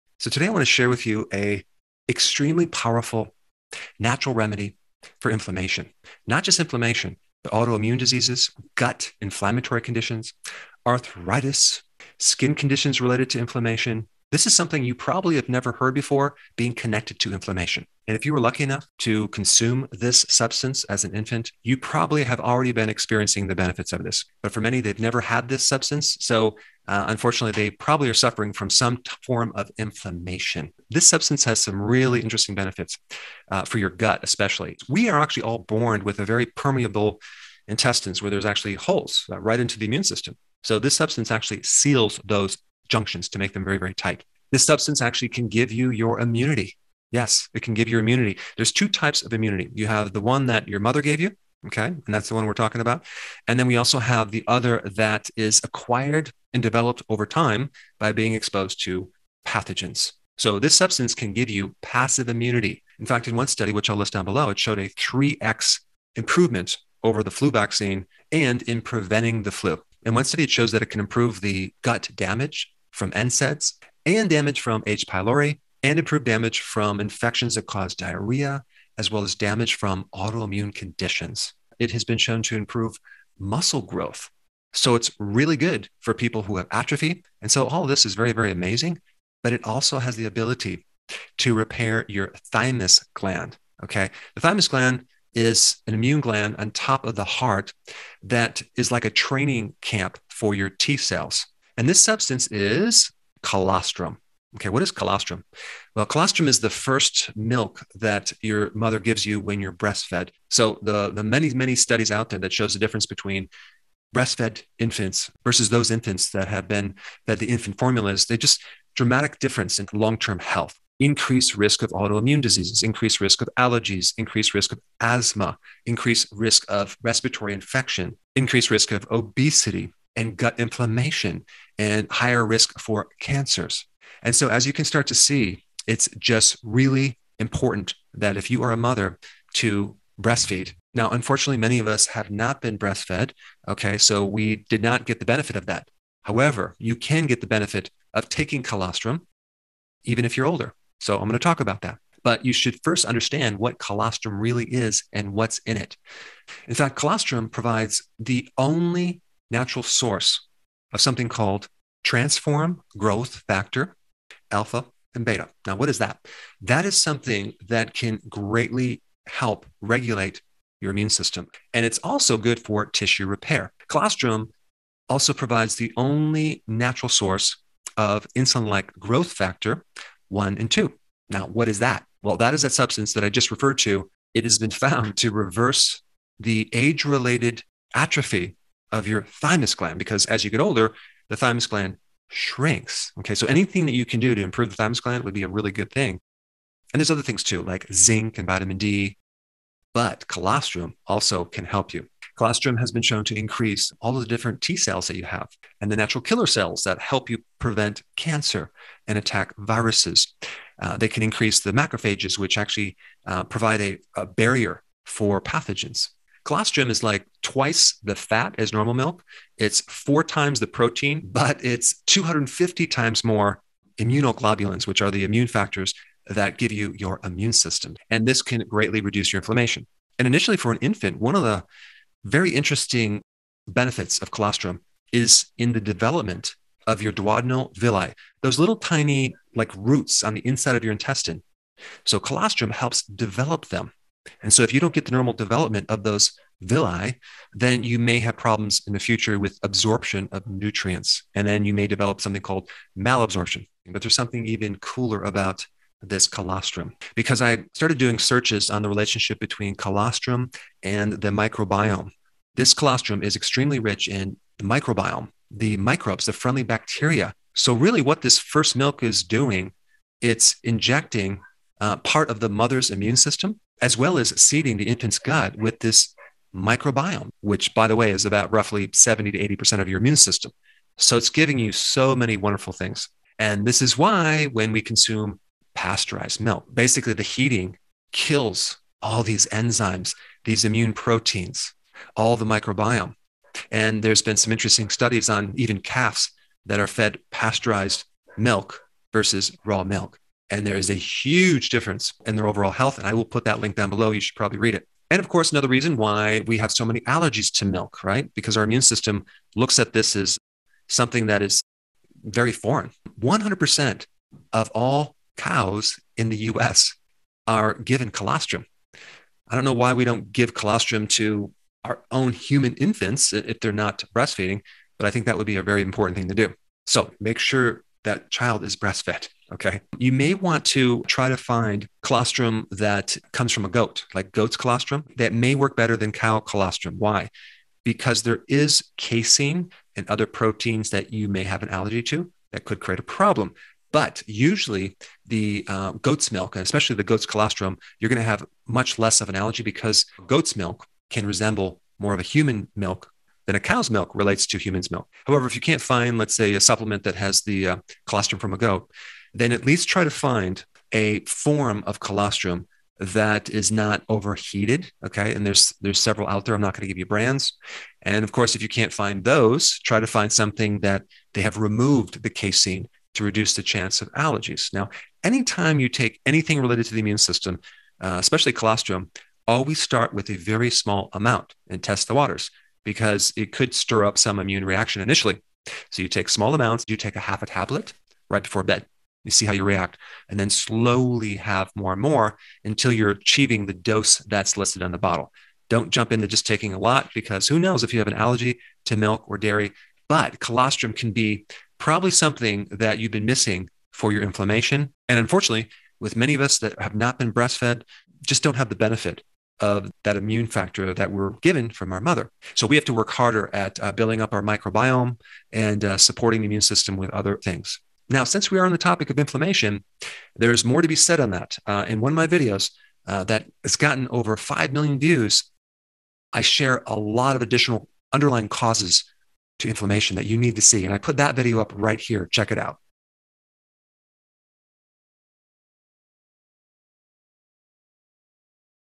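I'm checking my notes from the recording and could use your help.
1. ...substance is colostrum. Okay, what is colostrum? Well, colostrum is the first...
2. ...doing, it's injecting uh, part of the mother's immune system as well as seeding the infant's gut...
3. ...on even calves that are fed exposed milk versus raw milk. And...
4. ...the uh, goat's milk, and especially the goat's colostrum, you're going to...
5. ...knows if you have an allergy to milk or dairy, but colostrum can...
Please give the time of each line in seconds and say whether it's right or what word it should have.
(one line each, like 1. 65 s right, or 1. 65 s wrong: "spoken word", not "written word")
1. 102 s right
2. 269 s right
3. 295 s wrong: "pasteurized", not "exposed"
4. 345 s right
5. 397 s right.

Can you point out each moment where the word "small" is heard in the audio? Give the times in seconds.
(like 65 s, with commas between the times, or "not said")
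380 s, 386 s.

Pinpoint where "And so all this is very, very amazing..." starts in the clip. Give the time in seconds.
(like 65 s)
87 s.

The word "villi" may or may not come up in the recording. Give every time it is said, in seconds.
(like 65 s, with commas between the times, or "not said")
237 s, 246 s.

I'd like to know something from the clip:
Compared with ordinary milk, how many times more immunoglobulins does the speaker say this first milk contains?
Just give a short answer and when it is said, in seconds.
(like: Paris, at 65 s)
250 times, at 222 s.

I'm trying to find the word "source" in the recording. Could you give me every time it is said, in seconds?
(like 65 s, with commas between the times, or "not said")
159 s, 177 s.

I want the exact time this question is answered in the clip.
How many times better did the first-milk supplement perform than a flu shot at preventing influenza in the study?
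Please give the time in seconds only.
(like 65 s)
64 s.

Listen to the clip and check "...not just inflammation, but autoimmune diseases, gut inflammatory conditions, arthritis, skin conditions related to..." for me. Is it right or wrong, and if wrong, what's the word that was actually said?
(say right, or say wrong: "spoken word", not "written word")
right.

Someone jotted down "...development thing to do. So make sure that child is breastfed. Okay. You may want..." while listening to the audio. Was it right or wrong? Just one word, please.
wrong.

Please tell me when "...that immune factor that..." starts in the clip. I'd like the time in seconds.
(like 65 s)
410 s.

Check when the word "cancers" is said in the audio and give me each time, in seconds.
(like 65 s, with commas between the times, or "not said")
133 s, 208 s.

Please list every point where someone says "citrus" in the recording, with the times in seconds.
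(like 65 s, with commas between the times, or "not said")
not said.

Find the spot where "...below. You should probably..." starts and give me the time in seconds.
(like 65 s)
303 s.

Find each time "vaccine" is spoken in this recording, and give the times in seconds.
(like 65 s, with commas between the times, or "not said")
67 s.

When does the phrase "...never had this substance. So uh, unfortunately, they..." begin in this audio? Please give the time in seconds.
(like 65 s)
24 s.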